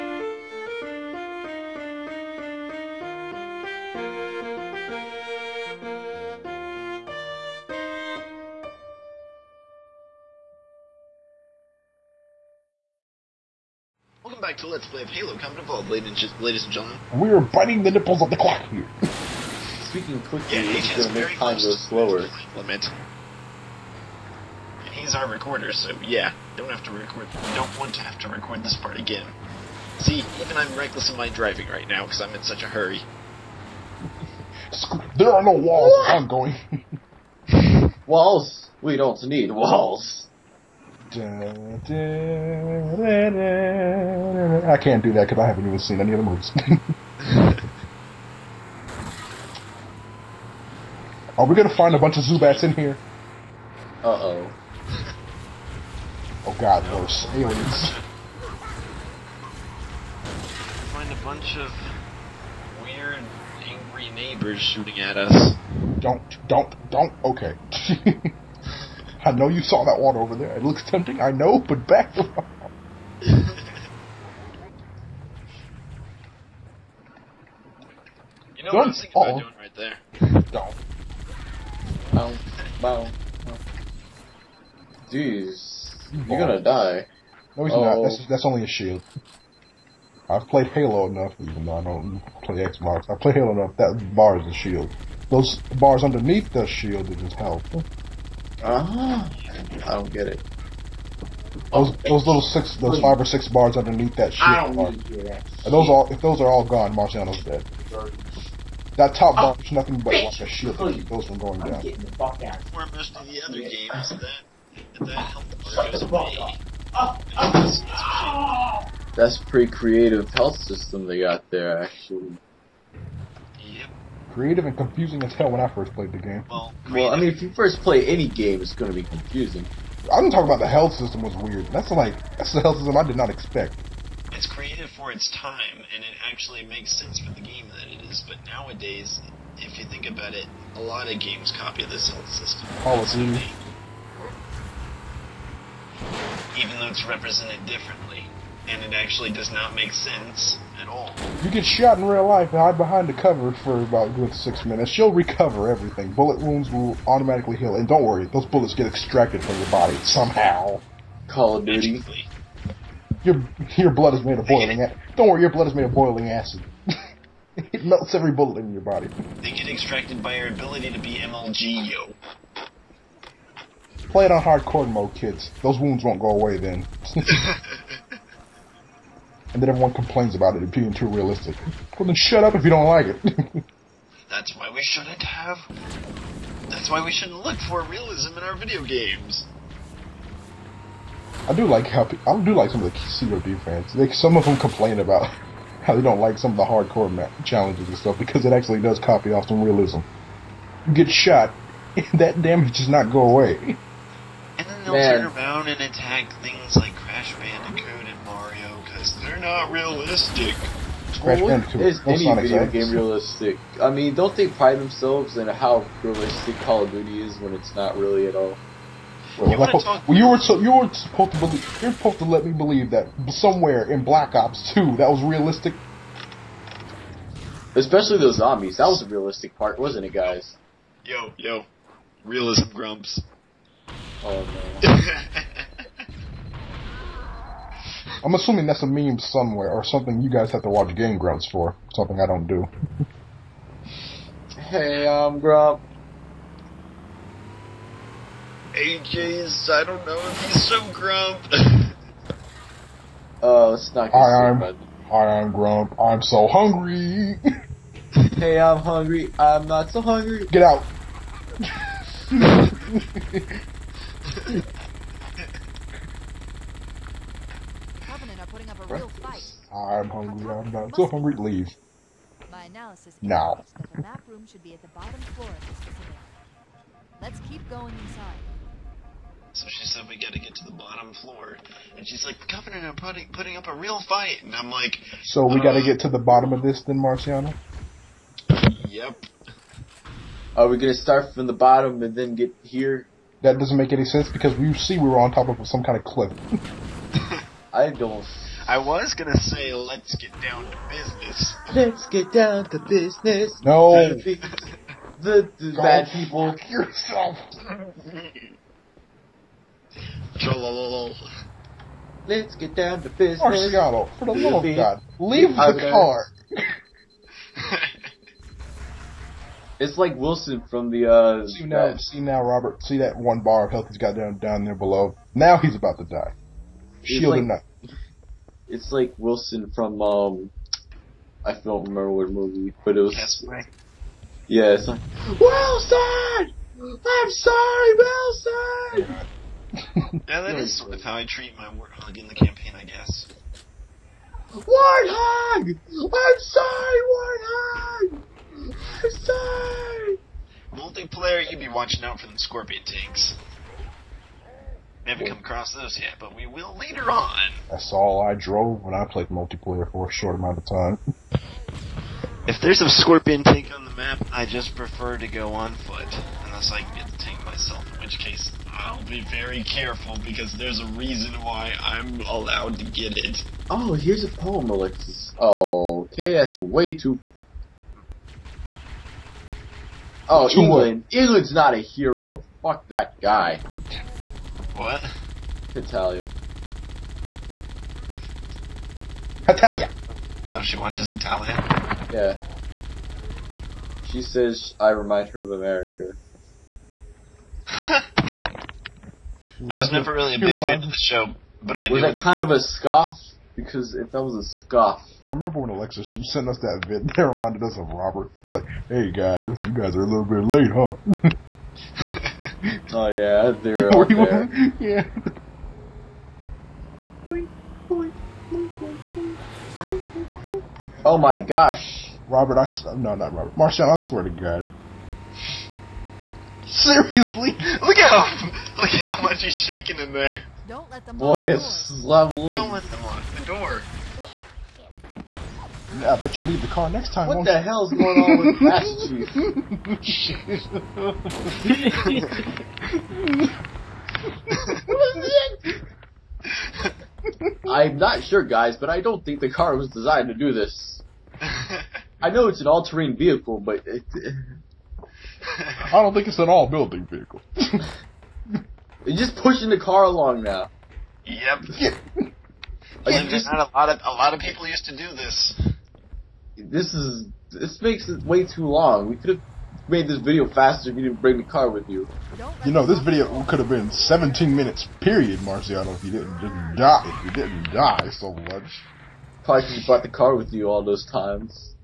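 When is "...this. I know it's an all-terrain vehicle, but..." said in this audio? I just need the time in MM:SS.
07:30.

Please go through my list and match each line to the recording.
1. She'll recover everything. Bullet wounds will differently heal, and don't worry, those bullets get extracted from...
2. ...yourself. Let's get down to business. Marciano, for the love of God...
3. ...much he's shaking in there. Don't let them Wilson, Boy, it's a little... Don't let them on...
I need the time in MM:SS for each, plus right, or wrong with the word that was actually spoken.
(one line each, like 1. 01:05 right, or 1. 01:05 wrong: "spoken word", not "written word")
1. 02:34 wrong: "automatically", not "differently"
2. 05:06 right
3. 07:09 wrong: "Boy", not "Wilson".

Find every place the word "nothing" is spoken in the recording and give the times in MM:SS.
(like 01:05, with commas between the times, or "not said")
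01:49.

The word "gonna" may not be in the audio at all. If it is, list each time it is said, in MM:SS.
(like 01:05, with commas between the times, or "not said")
00:51, 01:26, 04:50, 04:59.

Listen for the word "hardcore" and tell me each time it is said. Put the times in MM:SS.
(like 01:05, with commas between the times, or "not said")
02:54, 03:16.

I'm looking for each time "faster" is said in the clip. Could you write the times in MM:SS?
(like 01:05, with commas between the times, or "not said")
07:50.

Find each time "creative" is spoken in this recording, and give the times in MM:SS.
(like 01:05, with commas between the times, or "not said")
01:59, 02:04, 02:14.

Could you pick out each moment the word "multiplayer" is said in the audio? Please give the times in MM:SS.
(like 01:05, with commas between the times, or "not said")
05:50, 05:59.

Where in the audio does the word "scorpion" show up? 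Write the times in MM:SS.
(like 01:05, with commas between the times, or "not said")
05:52, 06:02.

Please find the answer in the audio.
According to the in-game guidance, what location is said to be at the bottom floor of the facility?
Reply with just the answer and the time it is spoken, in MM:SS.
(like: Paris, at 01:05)
The map room, at 04:33.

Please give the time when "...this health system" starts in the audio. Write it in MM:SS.
02:21.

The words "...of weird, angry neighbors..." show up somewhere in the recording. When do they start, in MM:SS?
01:01.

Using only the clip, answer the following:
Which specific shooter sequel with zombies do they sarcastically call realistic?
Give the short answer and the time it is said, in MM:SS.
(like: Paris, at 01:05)
Black Ops 2, at 03:44.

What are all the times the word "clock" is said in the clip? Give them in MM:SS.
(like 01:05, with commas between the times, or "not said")
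00:18.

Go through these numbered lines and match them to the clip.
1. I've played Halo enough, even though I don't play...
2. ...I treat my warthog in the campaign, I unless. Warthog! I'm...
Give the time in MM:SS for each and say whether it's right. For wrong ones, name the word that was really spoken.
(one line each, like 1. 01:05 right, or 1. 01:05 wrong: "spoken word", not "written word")
1. 01:30 right
2. 05:41 wrong: "guess", not "unless".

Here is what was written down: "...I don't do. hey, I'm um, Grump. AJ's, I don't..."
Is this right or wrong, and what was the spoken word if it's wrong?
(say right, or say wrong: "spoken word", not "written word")
right.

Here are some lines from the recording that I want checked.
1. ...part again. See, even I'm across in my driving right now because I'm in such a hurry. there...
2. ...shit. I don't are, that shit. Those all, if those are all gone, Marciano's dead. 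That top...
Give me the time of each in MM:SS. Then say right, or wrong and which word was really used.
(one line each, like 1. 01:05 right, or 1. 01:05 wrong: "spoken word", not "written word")
1. 00:28 wrong: "reckless", not "across"
2. 01:44 right.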